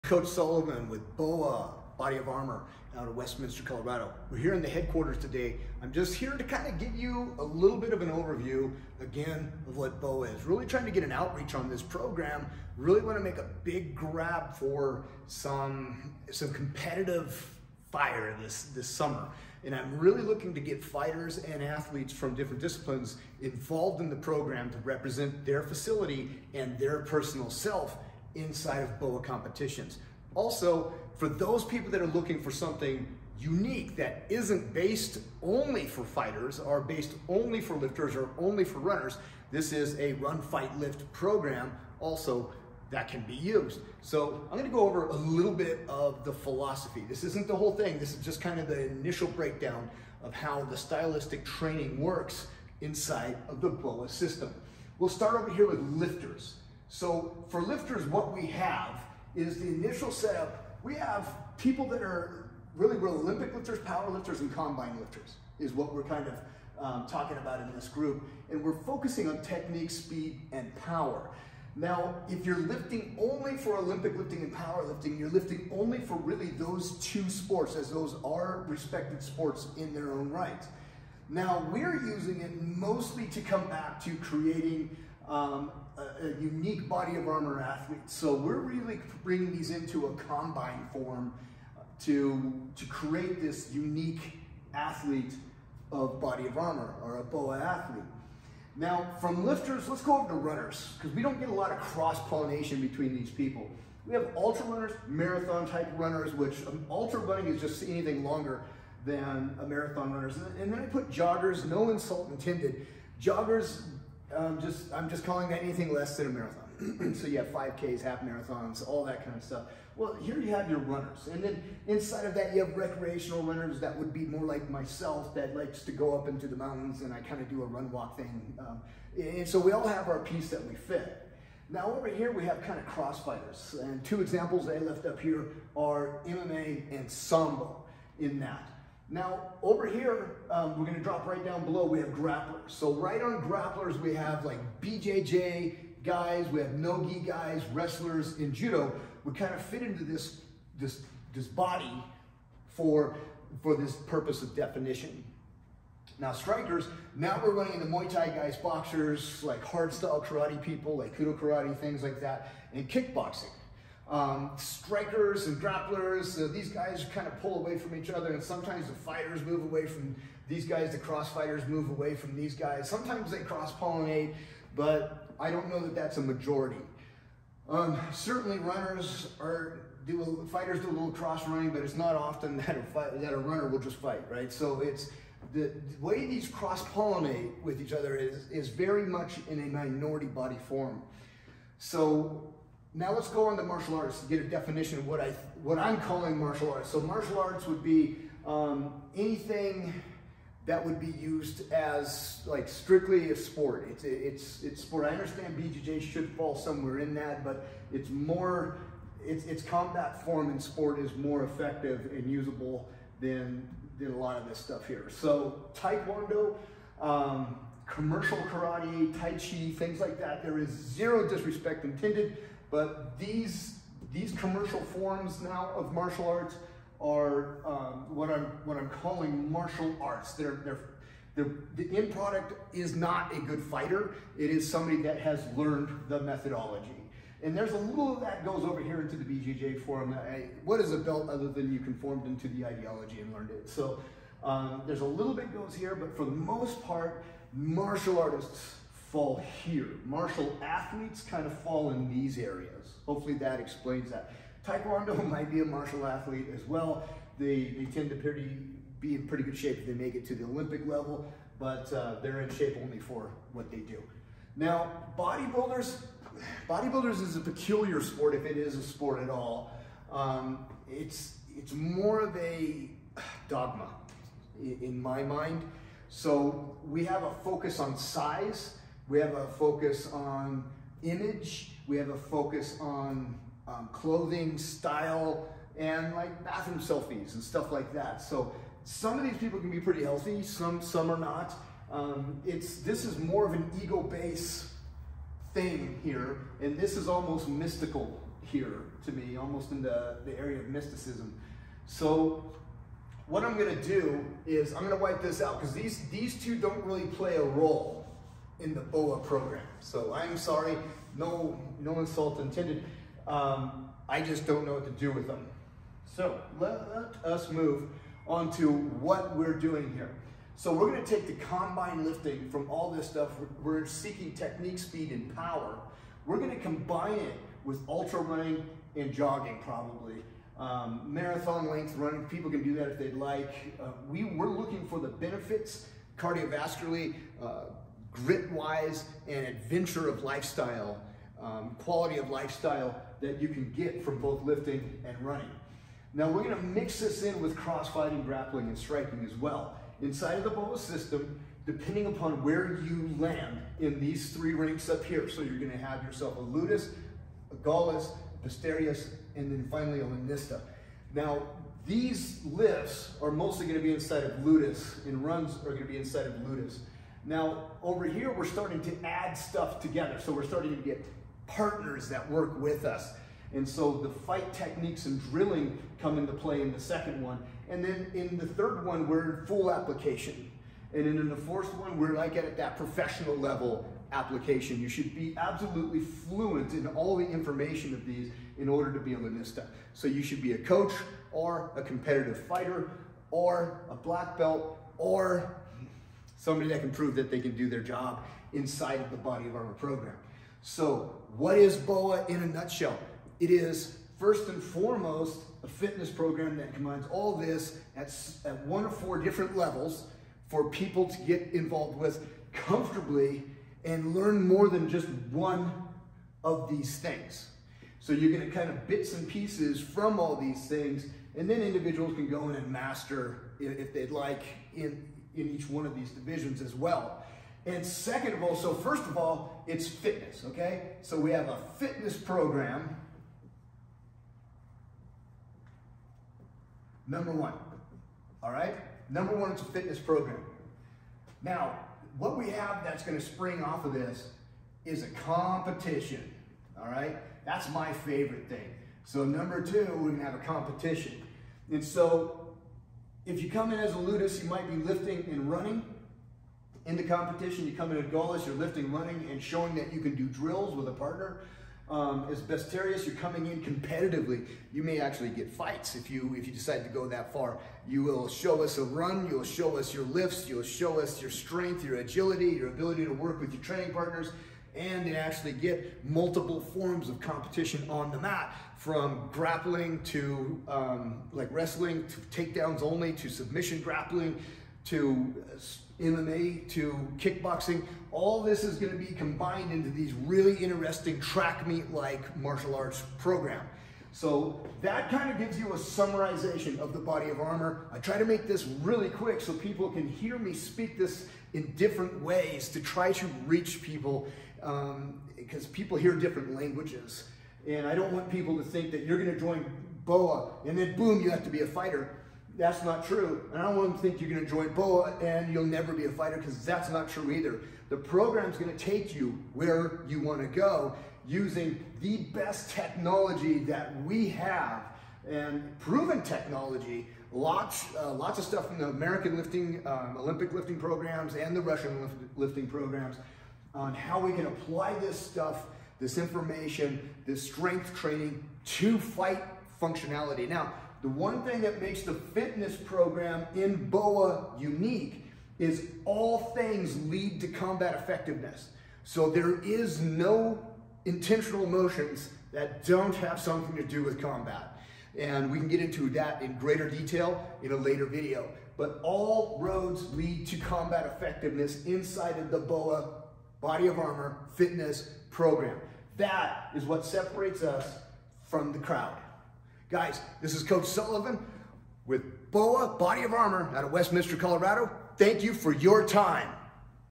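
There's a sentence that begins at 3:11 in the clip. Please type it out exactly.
So now let's go on to martial arts to get a definition of what I what I'm calling martial arts.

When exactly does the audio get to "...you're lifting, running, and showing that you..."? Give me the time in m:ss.
7:38.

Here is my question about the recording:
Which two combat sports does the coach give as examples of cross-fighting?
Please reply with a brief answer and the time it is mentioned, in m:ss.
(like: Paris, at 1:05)
MMA and Sambo, at 2:16.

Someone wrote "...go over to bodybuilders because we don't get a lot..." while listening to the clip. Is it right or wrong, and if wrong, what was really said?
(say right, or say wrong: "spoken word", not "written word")
wrong: "runners", not "bodybuilders".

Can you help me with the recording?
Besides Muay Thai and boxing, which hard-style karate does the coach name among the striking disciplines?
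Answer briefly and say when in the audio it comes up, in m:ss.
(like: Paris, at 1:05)
Kudo karate, at 2:41.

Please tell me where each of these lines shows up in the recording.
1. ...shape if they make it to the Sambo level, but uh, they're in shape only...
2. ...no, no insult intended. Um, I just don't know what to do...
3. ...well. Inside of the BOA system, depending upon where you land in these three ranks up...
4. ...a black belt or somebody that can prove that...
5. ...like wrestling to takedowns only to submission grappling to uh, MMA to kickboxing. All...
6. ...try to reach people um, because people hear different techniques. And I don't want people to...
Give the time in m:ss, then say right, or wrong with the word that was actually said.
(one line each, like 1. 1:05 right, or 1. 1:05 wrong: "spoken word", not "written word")
1. 4:19 wrong: "Olympic", not "Sambo"
2. 5:11 right
3. 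5:49 right
4. 6:33 right
5. 8:01 right
6. 8:22 wrong: "languages", not "techniques".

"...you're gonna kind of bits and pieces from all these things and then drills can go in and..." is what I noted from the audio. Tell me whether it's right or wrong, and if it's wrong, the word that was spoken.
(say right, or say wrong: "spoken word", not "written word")
wrong: "individuals", not "drills".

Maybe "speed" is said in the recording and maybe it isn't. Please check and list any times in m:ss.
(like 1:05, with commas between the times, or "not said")
1:09, 5:24.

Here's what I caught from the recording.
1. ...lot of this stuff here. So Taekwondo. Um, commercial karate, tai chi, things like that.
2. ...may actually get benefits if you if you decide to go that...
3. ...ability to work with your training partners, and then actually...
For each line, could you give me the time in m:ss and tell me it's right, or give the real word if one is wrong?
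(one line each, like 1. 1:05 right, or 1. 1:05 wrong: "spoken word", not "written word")
1. 3:34 right
2. 7:44 wrong: "fights", not "benefits"
3. 7:52 right.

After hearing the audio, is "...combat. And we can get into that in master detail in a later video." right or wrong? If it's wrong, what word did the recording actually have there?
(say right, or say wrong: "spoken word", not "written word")
wrong: "greater", not "master".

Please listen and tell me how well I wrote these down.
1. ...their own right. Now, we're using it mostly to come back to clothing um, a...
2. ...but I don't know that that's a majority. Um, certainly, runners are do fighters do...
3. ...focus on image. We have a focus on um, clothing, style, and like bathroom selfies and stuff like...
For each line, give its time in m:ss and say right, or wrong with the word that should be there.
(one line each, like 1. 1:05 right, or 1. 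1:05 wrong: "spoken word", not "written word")
1. 1:19 wrong: "creating", not "clothing"
2. 2:54 right
3. 4:39 right.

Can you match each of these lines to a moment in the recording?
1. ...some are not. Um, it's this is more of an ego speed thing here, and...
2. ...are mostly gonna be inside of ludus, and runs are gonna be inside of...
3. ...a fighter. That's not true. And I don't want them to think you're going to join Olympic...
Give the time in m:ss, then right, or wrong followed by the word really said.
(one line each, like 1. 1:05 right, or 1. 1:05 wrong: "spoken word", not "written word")
1. 4:50 wrong: "based", not "speed"
2. 6:03 right
3. 8:31 wrong: "BOA", not "Olympic".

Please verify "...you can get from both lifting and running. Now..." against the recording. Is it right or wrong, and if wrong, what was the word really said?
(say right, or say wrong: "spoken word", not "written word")
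right.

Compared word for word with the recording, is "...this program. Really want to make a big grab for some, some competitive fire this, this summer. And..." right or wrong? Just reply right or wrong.
right.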